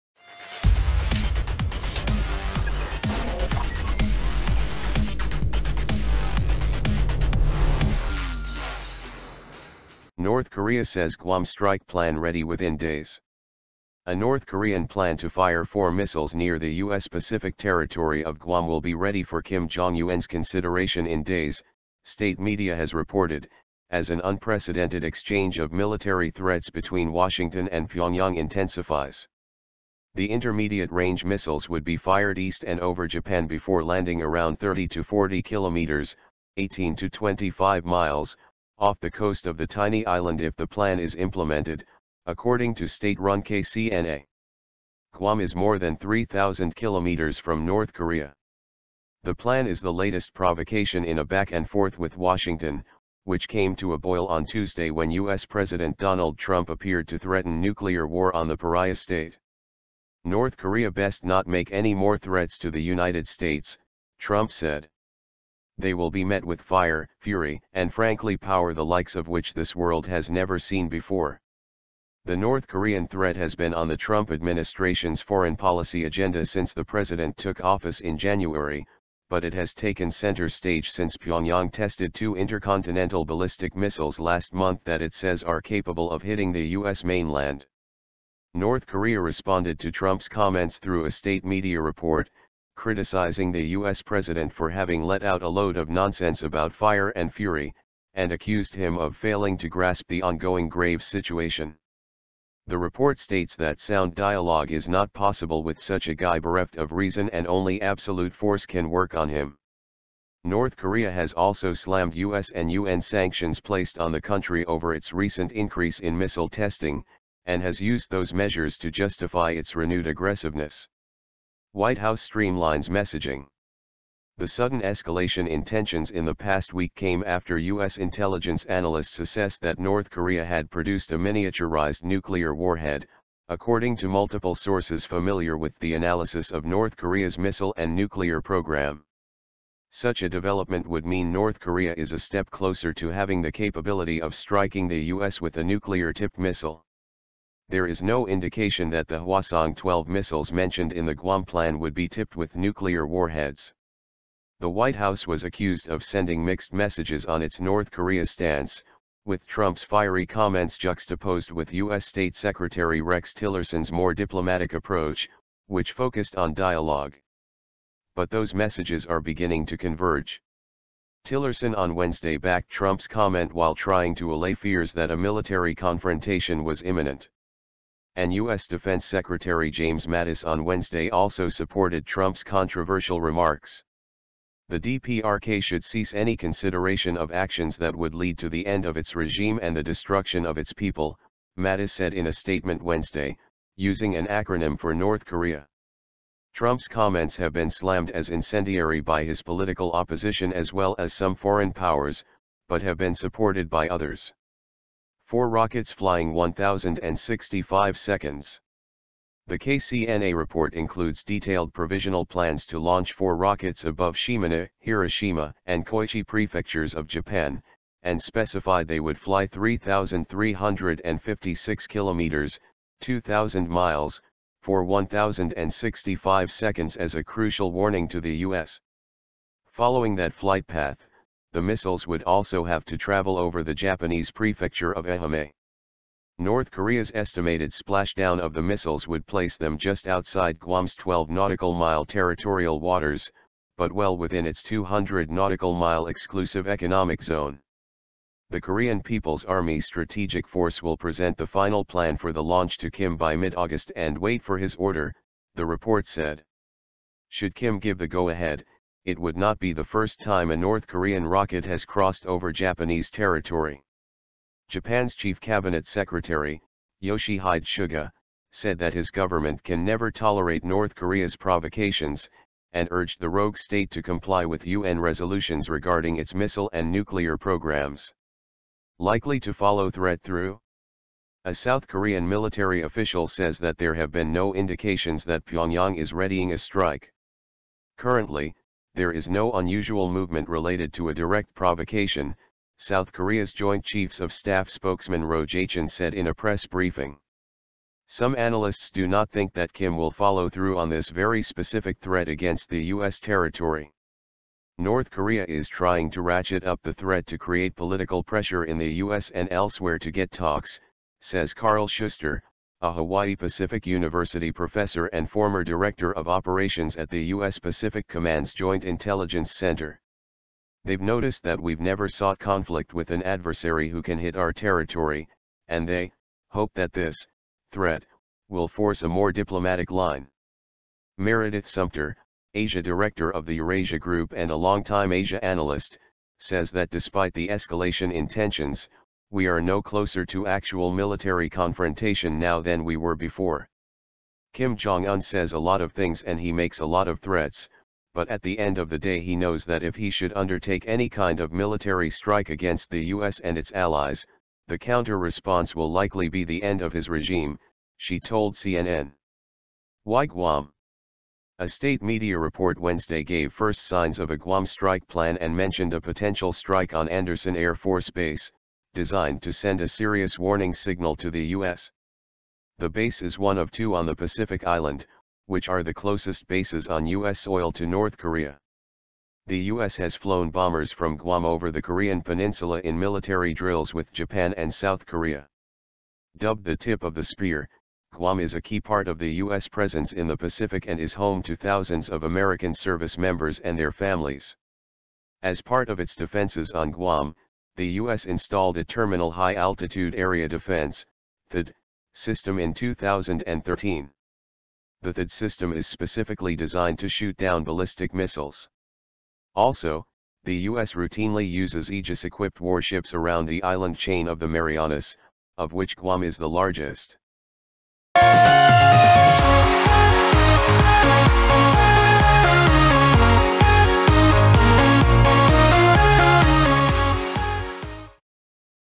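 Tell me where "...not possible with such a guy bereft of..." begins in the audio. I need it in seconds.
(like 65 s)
104 s.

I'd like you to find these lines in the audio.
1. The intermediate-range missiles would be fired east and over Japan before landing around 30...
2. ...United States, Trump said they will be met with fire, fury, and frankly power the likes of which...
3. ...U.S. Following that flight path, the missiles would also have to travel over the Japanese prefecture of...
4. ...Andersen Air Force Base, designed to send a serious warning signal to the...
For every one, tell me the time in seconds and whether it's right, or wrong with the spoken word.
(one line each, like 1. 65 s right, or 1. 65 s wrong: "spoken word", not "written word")
1. 30 s right
2. 62 s right
3. 228 s right
4. 367 s right.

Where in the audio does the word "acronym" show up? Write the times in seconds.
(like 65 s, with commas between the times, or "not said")
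194 s.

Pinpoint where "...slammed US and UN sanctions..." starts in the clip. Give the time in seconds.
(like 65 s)
111 s.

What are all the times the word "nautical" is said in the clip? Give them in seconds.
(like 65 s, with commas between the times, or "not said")
241 s, 245 s.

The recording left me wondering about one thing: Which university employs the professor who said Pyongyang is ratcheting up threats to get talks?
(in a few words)
Hawaii Pacific University.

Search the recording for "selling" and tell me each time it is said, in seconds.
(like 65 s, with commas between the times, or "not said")
not said.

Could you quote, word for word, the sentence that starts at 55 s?
President Donald Trump appeared to threaten nuclear war on the pariah state.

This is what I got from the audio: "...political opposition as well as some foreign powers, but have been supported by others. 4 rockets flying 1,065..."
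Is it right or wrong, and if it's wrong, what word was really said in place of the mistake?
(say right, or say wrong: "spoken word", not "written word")
right.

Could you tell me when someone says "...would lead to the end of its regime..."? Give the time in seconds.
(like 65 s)
187 s.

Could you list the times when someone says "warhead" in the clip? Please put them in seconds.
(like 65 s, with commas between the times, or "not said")
132 s, 153 s.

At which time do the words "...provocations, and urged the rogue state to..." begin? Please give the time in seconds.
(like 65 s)
271 s.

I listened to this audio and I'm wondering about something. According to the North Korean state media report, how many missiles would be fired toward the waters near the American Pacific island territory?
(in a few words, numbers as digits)
4.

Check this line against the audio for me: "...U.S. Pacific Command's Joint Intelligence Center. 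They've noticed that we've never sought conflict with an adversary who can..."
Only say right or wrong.
right.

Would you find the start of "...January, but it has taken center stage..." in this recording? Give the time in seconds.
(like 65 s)
78 s.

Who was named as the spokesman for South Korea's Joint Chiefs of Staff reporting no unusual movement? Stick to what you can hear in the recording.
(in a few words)
Ro Jae-chin.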